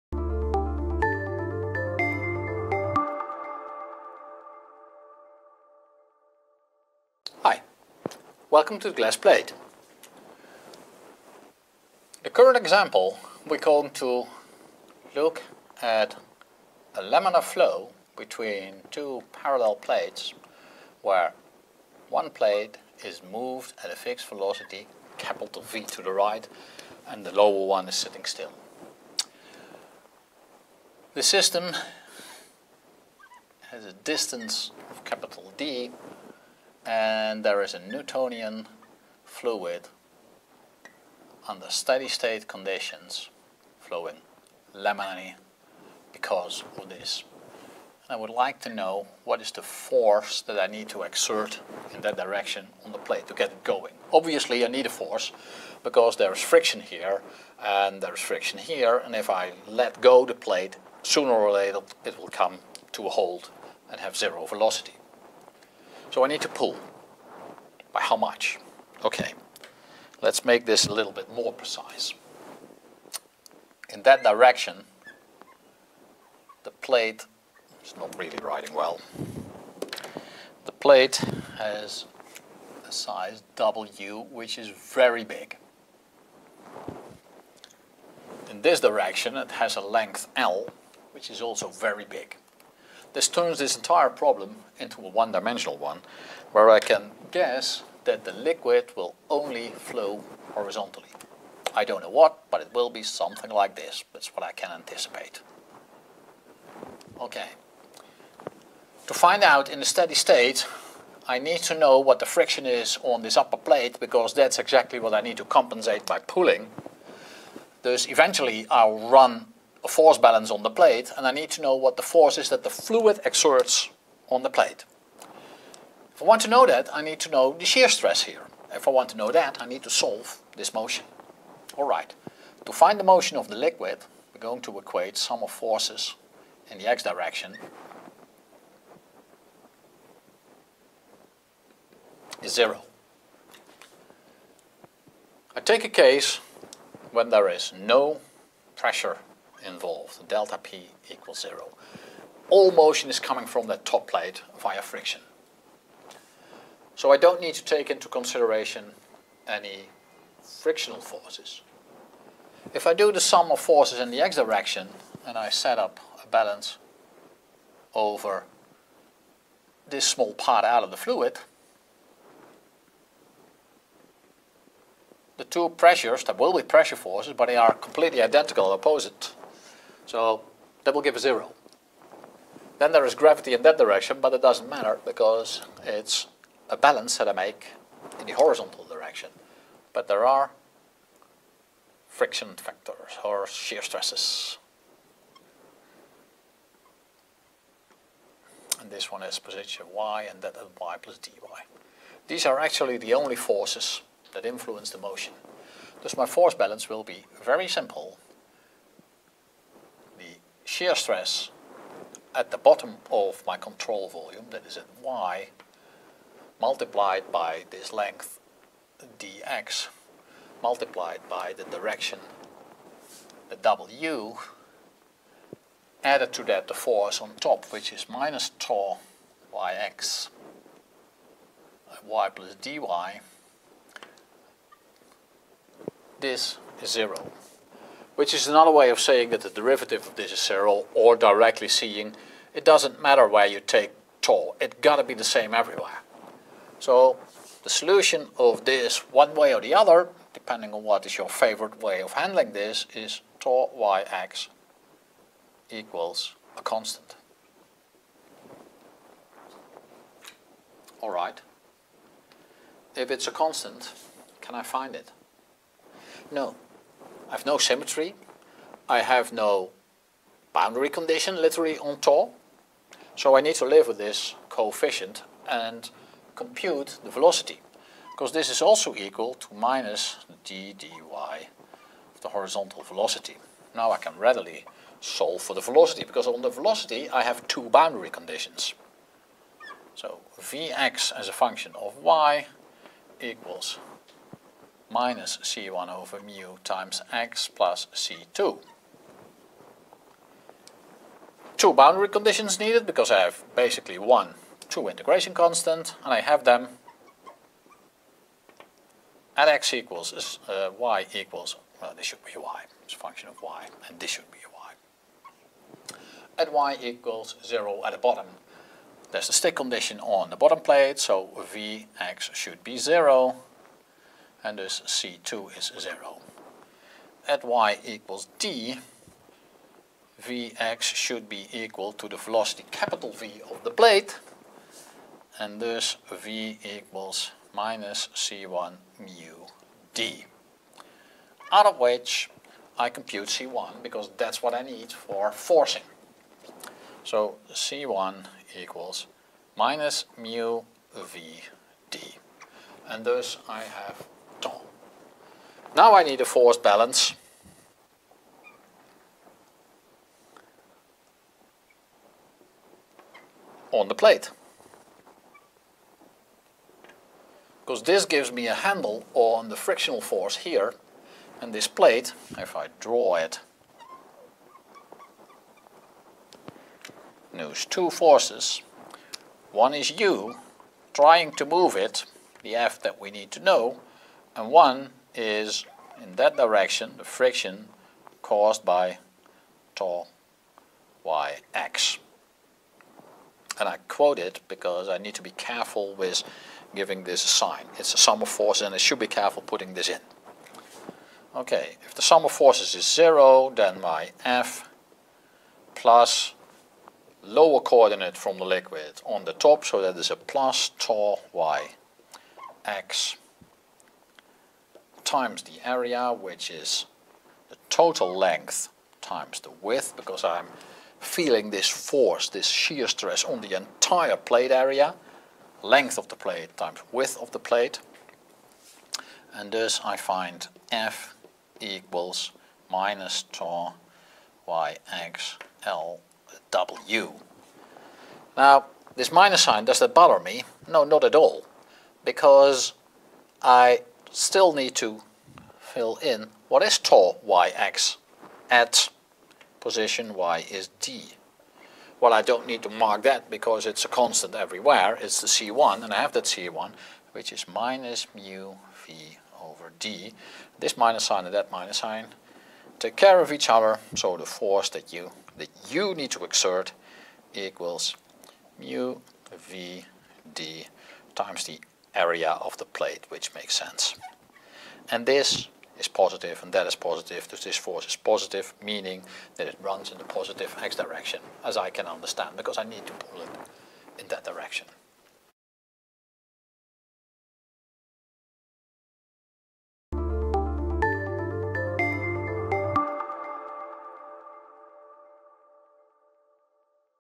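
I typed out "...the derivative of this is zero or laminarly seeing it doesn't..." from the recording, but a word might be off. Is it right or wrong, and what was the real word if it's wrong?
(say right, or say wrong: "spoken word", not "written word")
wrong: "directly", not "laminarly".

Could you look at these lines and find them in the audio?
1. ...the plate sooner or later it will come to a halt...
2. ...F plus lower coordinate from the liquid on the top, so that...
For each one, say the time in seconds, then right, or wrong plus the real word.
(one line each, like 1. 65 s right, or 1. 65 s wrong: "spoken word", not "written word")
1. 60 s right
2. 404 s right.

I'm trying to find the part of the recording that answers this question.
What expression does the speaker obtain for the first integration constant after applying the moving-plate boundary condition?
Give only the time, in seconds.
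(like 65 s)
349 s.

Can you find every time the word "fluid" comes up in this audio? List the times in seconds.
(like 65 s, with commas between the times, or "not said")
39 s, 122 s, 170 s.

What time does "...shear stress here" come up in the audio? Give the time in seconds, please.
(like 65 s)
127 s.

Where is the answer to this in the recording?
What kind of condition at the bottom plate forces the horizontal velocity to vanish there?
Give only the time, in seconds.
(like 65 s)
319 s.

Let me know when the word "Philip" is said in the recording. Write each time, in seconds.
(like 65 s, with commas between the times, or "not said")
not said.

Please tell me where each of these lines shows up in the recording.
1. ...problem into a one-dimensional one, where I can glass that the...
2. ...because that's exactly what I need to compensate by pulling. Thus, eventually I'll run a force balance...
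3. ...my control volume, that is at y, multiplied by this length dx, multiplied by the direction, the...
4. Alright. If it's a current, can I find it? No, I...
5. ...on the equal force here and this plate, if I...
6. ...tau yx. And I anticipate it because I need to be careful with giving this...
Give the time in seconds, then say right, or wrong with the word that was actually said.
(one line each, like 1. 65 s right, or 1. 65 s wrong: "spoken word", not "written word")
1. 94 s wrong: "guess", not "glass"
2. 113 s right
3. 213 s right
4. 261 s wrong: "constant", not "current"
5. 369 s wrong: "frictional", not "equal"
6. 389 s wrong: "quote", not "anticipate".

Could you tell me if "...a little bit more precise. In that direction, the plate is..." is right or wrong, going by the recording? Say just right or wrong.
right.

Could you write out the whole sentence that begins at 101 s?
I don't know what, but it will be something like this.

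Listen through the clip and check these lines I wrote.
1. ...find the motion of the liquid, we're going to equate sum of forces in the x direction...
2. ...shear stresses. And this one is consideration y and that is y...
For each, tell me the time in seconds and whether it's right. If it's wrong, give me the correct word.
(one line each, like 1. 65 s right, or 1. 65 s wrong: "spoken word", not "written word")
1. 132 s right
2. 193 s wrong: "position", not "consideration".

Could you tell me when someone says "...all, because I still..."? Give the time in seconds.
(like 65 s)
441 s.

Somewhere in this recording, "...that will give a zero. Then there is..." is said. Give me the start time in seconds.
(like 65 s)
180 s.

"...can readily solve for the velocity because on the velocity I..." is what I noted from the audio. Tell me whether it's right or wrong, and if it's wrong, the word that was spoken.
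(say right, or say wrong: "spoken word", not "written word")
right.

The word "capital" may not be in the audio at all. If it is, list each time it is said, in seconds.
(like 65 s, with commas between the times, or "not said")
25 s, 35 s, 332 s.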